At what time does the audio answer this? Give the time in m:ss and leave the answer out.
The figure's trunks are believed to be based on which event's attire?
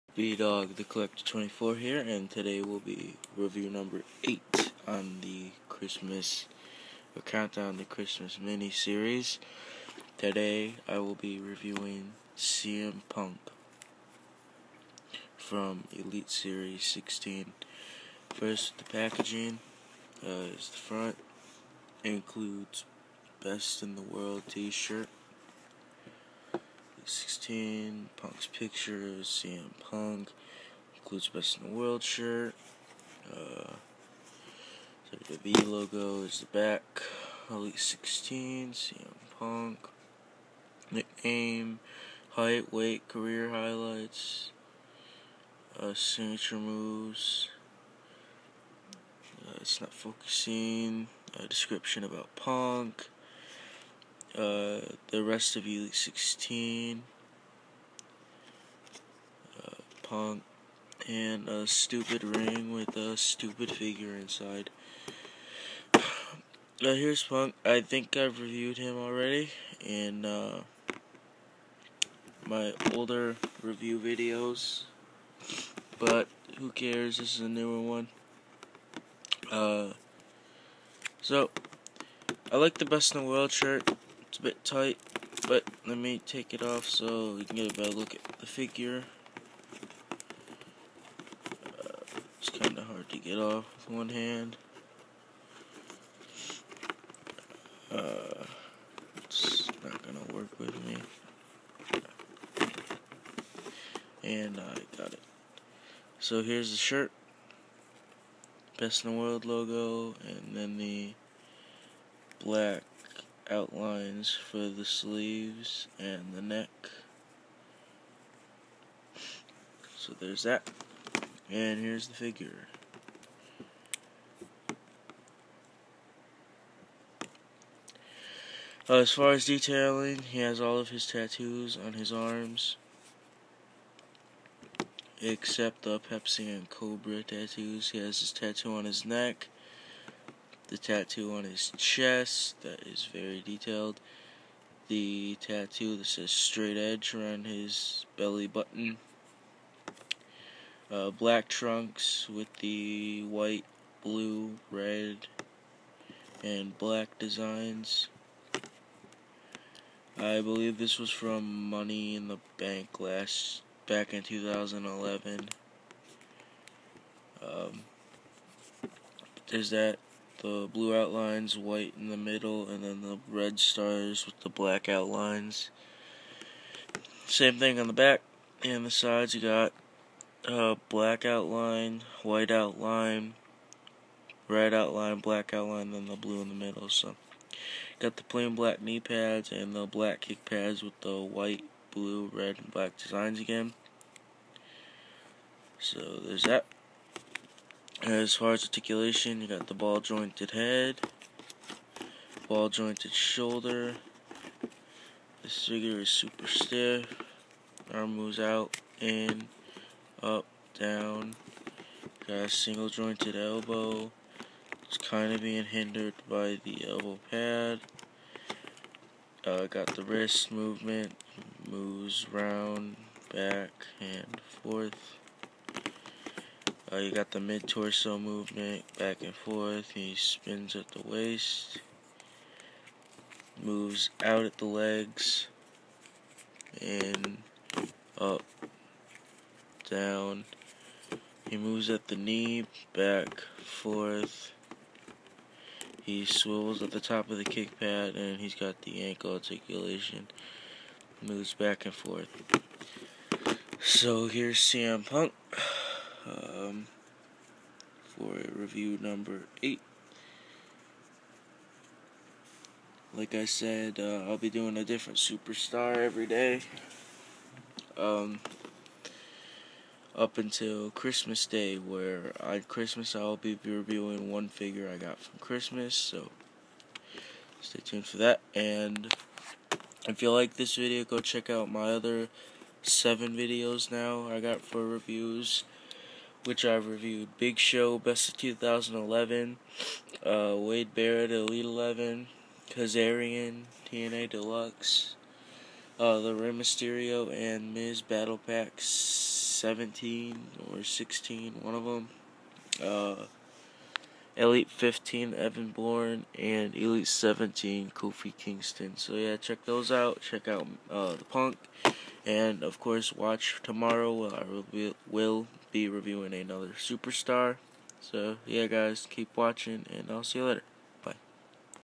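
2:41.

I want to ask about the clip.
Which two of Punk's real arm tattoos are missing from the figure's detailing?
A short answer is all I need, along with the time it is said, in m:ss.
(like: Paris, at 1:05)
Pepsi and Cobra, at 2:15.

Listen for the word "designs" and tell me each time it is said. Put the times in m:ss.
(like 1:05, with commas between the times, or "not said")
2:37, 3:12.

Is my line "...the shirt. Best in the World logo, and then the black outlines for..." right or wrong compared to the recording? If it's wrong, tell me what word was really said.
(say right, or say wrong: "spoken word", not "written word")
right.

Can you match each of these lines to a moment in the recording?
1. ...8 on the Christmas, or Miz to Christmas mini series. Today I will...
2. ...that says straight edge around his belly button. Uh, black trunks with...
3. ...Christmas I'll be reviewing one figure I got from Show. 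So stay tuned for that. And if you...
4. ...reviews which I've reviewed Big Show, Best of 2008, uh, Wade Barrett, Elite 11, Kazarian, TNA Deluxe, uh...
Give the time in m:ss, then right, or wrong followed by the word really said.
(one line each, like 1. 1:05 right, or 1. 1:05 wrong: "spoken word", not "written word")
1. 0:04 wrong: "Countdown", not "Miz"
2. 2:25 right
3. 4:32 wrong: "Christmas", not "Show"
4. 4:44 wrong: "2011", not "2008".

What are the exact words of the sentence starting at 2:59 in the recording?
You got uh, black outline, white outline, red outline, black outline, then the blue in the middle.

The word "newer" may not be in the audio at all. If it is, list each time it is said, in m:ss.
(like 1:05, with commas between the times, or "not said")
1:17.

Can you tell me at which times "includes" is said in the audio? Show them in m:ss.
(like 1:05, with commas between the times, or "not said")
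0:22, 0:30.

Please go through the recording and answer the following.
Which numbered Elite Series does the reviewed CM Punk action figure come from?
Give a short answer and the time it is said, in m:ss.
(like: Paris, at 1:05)
16, at 0:15.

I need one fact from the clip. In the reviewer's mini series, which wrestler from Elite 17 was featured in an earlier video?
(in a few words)
Kofi Kingston.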